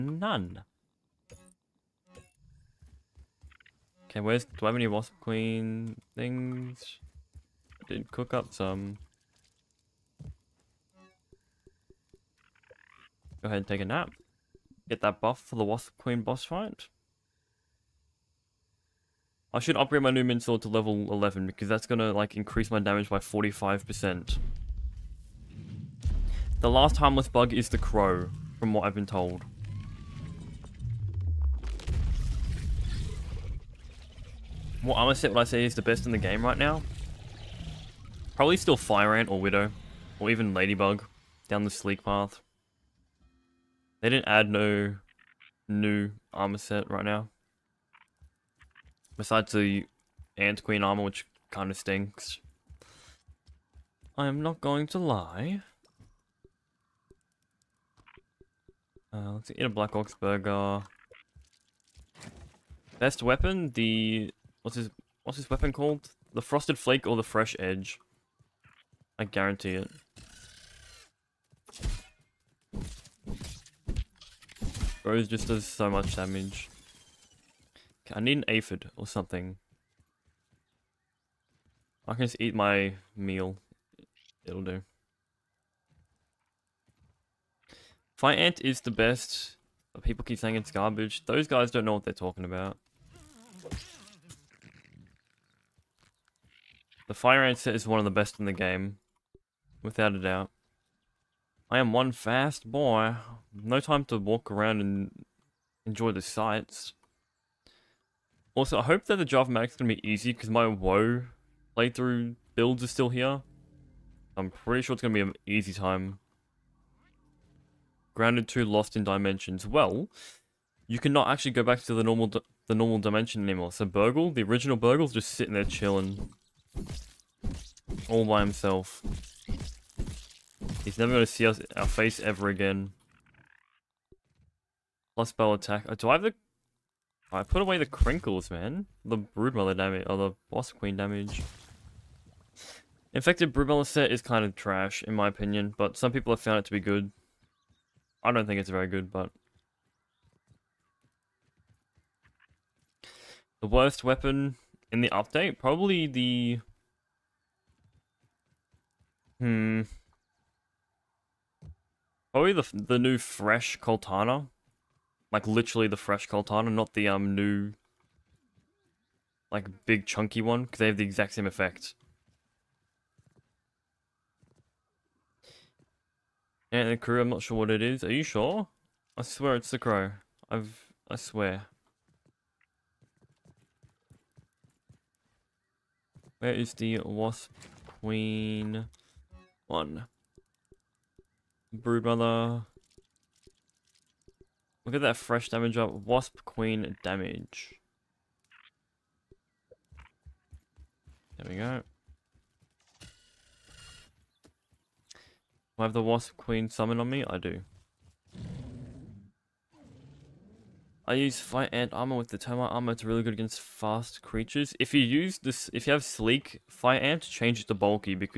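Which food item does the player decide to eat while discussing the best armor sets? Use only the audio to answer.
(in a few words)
Black Ox burger.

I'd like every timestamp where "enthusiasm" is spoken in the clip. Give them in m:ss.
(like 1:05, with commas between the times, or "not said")
not said.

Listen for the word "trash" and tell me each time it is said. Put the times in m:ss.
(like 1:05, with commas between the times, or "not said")
2:24.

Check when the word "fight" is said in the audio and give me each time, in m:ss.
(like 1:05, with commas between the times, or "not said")
0:16.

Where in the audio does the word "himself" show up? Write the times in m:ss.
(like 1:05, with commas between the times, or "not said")
2:08.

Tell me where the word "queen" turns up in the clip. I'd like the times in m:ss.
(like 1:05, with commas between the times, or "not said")
0:05, 0:15, 0:50, 2:20, 3:07, 3:16, 3:26.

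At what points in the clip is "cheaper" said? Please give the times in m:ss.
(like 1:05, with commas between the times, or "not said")
not said.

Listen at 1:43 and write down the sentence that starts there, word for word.
No time to walk around and enjoy the sights.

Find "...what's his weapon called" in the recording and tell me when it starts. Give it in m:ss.
1:05.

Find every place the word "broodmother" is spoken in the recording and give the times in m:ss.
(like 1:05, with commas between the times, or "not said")
2:19, 2:23, 3:11.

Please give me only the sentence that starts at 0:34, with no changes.
What armor set would I say is the best in the game right now?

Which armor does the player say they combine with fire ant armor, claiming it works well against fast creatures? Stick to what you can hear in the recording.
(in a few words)
termite armor.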